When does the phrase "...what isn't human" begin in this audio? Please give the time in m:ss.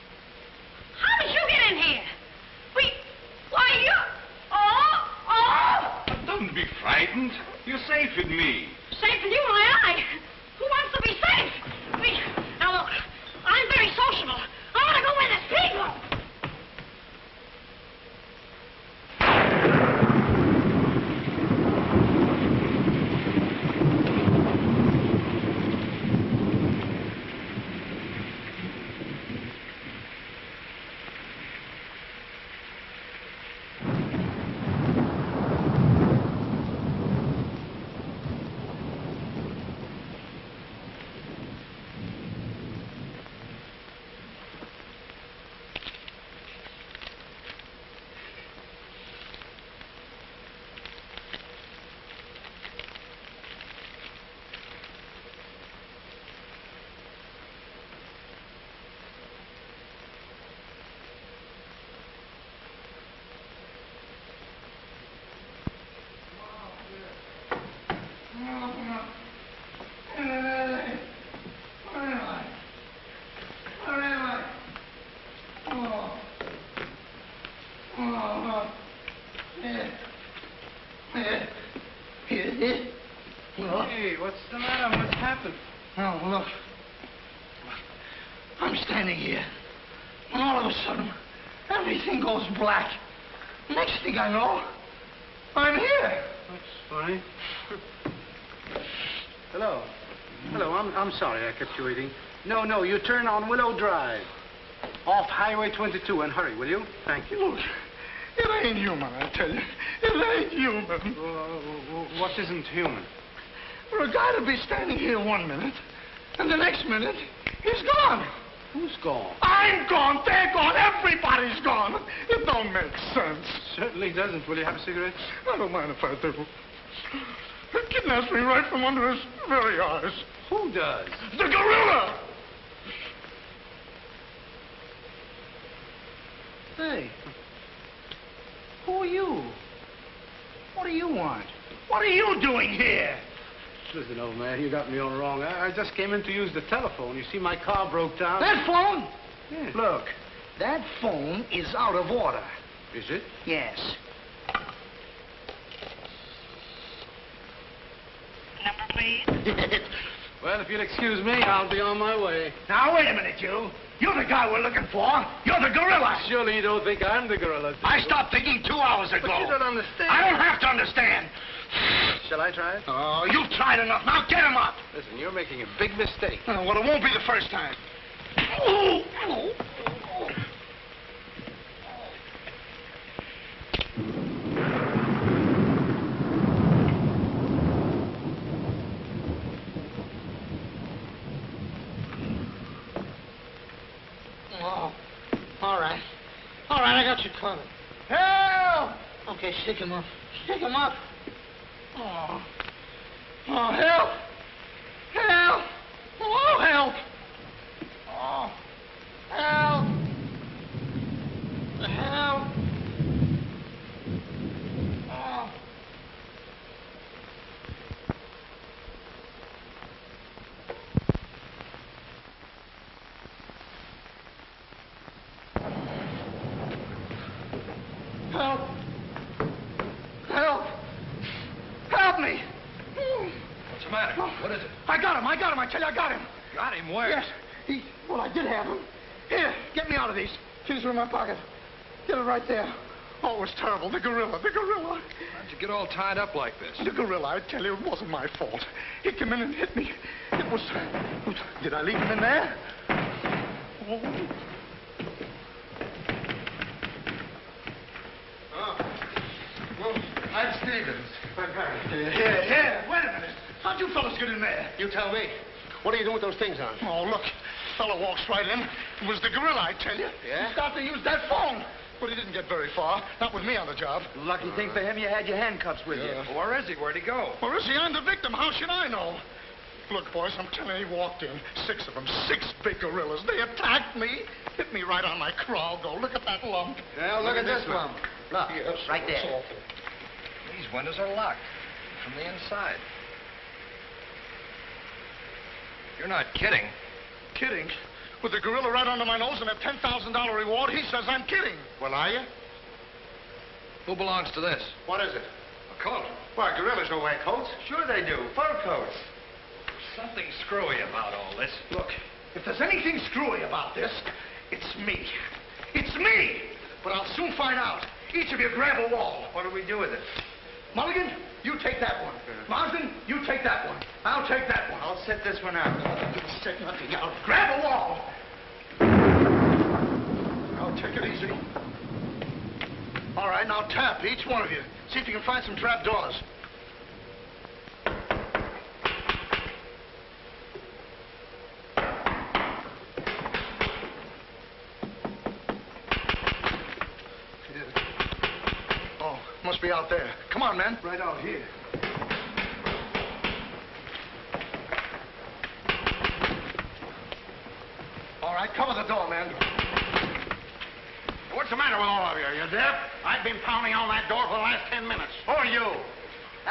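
1:52.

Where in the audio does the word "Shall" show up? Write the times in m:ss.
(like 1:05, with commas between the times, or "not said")
2:52.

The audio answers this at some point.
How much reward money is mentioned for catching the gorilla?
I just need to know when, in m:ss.
4:59.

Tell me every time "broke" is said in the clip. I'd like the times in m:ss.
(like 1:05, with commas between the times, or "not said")
2:27.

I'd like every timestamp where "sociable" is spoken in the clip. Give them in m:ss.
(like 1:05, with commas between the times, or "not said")
0:13.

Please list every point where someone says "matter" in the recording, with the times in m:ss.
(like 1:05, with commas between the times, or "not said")
1:24, 6:01.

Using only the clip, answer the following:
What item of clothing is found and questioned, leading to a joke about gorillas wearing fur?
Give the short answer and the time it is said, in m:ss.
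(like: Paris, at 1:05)
A coat, at 5:05.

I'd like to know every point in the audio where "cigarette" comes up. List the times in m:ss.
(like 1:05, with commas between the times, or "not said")
2:04.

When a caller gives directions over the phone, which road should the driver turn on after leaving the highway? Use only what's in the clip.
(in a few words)
Willow Drive.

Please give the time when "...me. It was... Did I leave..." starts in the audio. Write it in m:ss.
4:09.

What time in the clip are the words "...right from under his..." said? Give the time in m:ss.
2:08.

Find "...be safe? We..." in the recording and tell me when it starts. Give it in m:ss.
0:11.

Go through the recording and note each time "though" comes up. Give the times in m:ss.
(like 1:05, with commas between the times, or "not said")
4:45.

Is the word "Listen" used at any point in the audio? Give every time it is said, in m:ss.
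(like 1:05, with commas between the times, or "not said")
2:23, 2:54.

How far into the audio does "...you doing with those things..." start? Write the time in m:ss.
4:25.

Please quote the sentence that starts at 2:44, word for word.
You're the guy we're looking for.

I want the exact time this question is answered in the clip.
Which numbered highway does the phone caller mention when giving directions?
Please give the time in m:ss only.
1:45.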